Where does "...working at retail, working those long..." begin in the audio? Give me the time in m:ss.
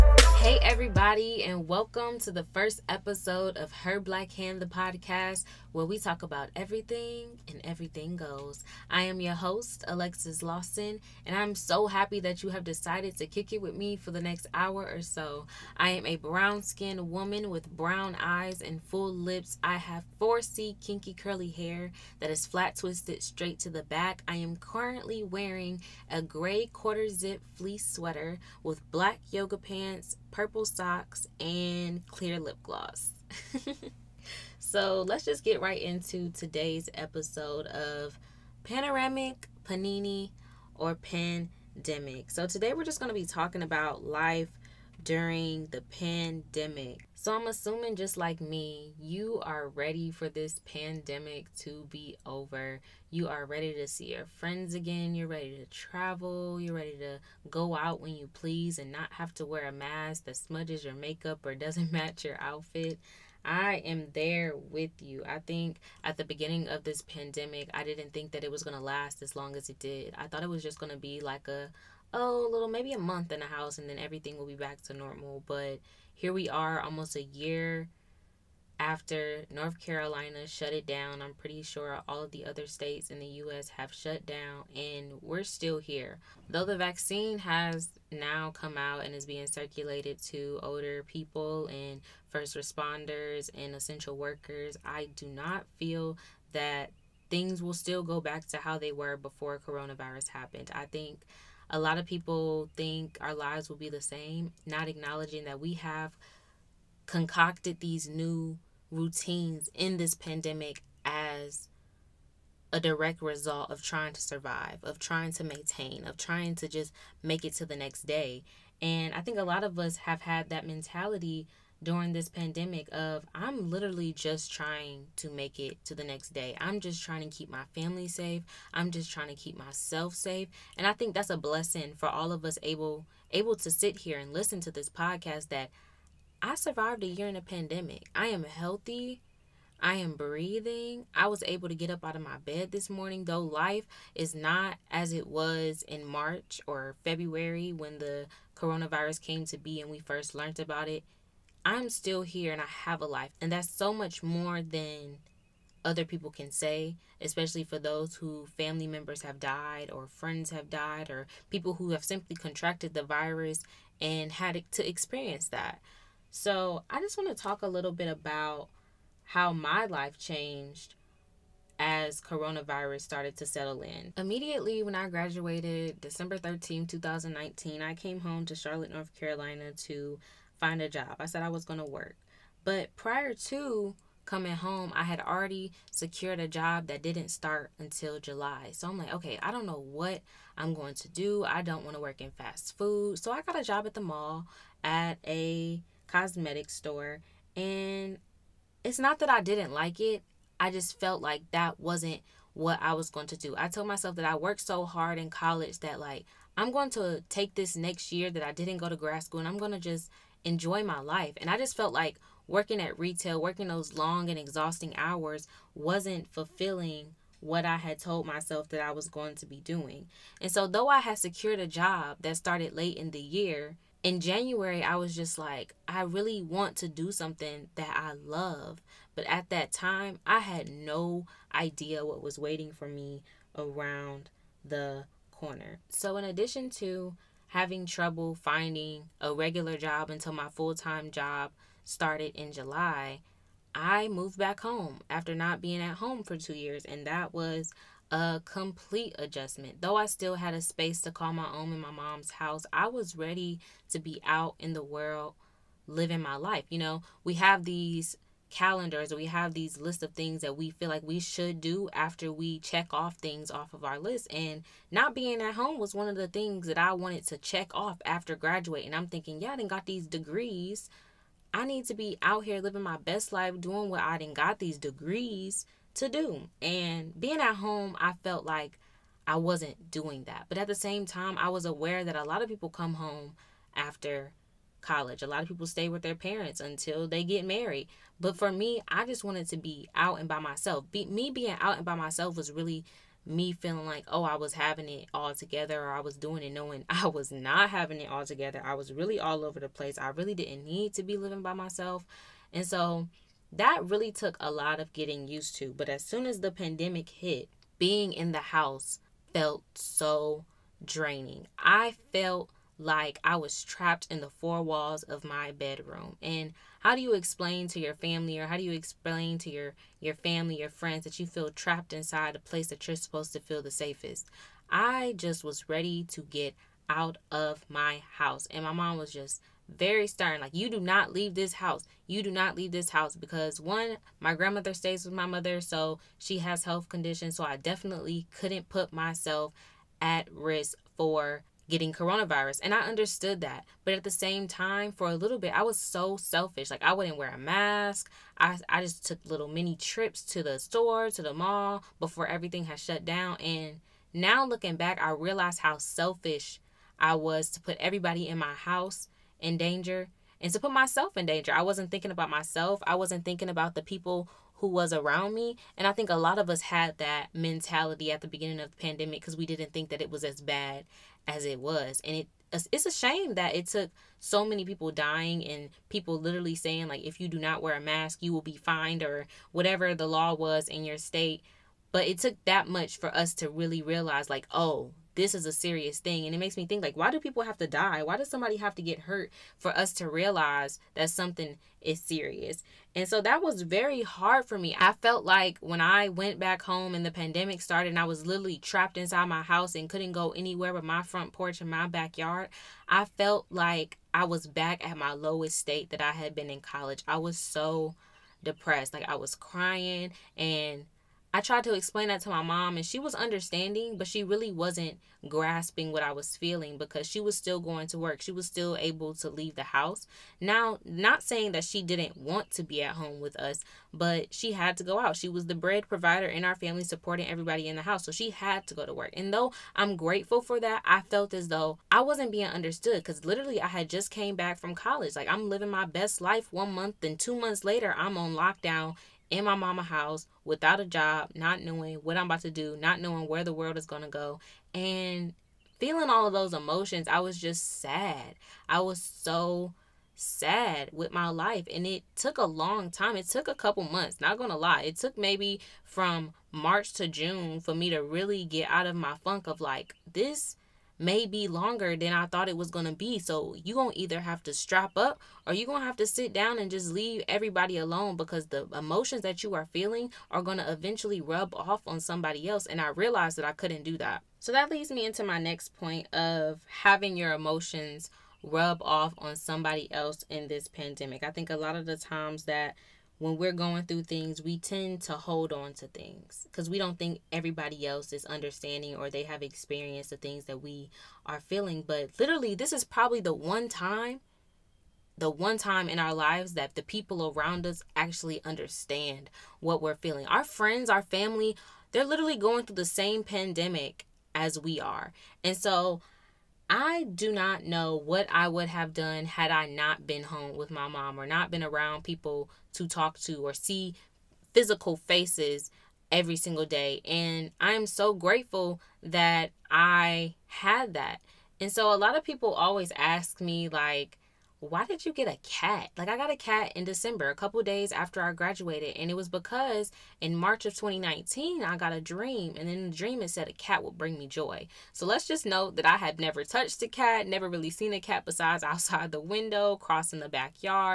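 3:32.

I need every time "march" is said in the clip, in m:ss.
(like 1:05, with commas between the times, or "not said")
2:26, 7:36, 8:50.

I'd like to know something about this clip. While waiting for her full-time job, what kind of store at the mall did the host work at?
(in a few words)
Cosmetic store.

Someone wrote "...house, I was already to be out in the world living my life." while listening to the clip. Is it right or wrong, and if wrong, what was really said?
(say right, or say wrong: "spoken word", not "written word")
wrong: "ready", not "already".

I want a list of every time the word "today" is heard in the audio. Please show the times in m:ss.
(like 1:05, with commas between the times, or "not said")
0:36, 0:42.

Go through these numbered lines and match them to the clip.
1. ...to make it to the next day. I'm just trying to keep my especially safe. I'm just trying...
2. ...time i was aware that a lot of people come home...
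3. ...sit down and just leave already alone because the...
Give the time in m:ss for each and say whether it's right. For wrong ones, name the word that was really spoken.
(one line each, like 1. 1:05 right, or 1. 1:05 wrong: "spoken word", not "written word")
1. 2:05 wrong: "family", not "especially"
2. 4:41 right
3. 7:46 wrong: "everybody", not "already".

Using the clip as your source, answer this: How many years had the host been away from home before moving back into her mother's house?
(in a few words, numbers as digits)
2.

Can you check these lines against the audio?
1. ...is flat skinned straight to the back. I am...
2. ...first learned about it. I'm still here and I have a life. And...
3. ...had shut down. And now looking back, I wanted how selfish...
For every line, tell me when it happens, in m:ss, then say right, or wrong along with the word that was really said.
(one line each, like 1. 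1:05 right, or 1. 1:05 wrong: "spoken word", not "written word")
1. 0:22 wrong: "twisted", not "skinned"
2. 2:29 right
3. 5:52 wrong: "realized", not "wanted".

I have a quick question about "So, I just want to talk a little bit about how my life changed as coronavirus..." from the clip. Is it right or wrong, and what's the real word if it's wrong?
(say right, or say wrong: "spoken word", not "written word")
right.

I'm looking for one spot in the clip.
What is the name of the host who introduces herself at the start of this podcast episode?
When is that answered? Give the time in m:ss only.
0:09.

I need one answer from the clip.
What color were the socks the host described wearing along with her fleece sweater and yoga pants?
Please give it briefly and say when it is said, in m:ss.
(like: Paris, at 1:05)
Purple, at 0:30.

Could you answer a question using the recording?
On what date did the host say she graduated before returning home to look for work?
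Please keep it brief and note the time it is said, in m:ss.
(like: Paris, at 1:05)
December 13, 2019, at 2:56.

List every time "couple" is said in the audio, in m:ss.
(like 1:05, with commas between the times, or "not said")
7:33, 8:47.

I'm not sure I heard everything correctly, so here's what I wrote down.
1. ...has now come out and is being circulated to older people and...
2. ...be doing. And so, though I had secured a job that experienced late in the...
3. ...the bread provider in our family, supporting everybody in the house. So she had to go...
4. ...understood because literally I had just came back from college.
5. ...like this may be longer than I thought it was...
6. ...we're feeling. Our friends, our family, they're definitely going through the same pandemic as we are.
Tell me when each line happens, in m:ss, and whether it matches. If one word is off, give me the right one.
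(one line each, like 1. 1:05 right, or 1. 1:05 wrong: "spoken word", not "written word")
1. 1:27 right
2. 3:39 wrong: "started", not "experienced"
3. 7:05 right
4. 7:12 right
5. 7:39 right
6. 8:19 wrong: "literally", not "definitely".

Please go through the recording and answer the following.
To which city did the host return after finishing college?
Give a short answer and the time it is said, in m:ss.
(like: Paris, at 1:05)
Charlotte, at 2:58.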